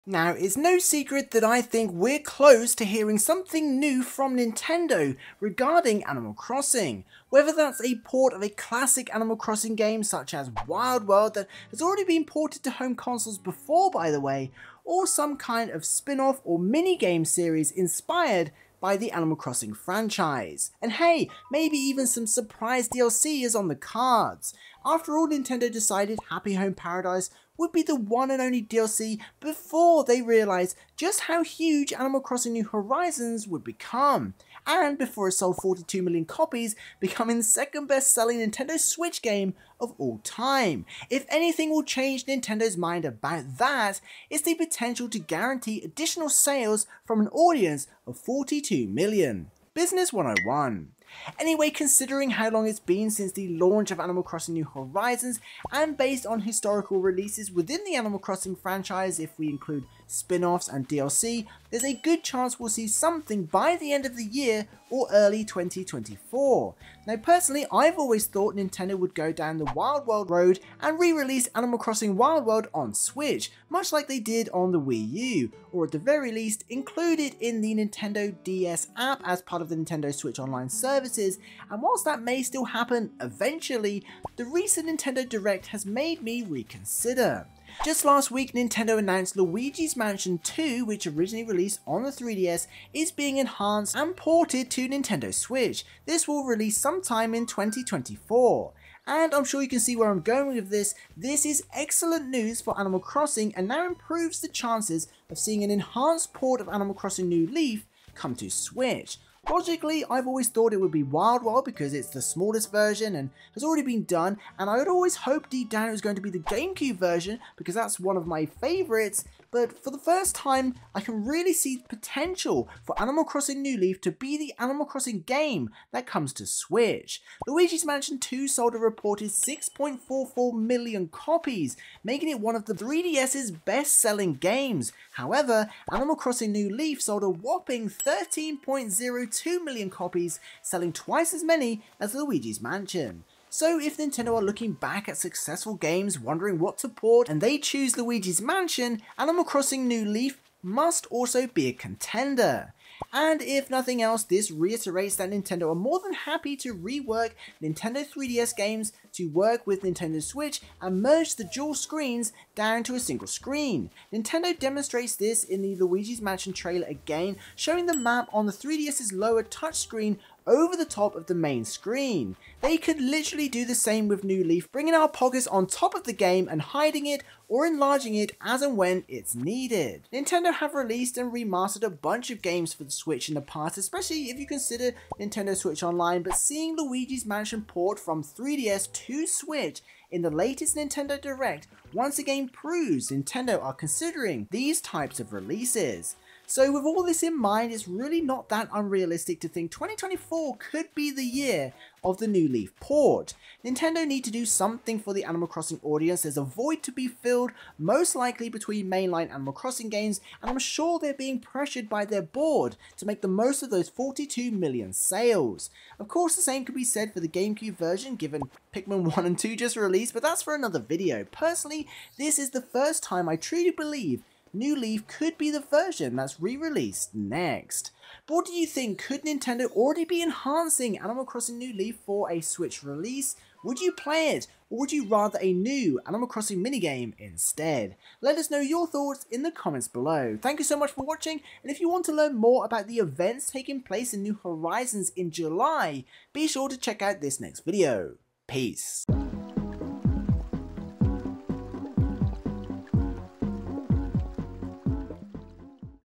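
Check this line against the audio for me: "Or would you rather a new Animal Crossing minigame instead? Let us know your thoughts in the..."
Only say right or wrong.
right.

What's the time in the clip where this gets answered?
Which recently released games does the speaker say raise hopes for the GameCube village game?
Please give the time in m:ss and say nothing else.
3:38.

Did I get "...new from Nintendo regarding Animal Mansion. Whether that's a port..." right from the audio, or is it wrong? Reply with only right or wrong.
wrong.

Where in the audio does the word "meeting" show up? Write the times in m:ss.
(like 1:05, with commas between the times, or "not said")
not said.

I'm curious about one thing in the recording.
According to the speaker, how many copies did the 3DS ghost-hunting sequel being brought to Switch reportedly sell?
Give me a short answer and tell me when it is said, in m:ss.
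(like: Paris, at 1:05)
6.44 million, at 2:09.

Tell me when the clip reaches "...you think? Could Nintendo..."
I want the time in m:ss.
3:48.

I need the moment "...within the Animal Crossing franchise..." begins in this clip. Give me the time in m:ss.
0:57.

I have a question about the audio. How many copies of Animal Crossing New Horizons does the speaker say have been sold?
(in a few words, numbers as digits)
42 million.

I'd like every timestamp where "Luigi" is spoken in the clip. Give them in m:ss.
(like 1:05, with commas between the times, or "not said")
1:29, 2:07, 2:22, 2:27, 2:45, 3:06.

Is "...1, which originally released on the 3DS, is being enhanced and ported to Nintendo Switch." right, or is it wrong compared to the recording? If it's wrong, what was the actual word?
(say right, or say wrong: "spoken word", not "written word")
wrong: "2", not "1".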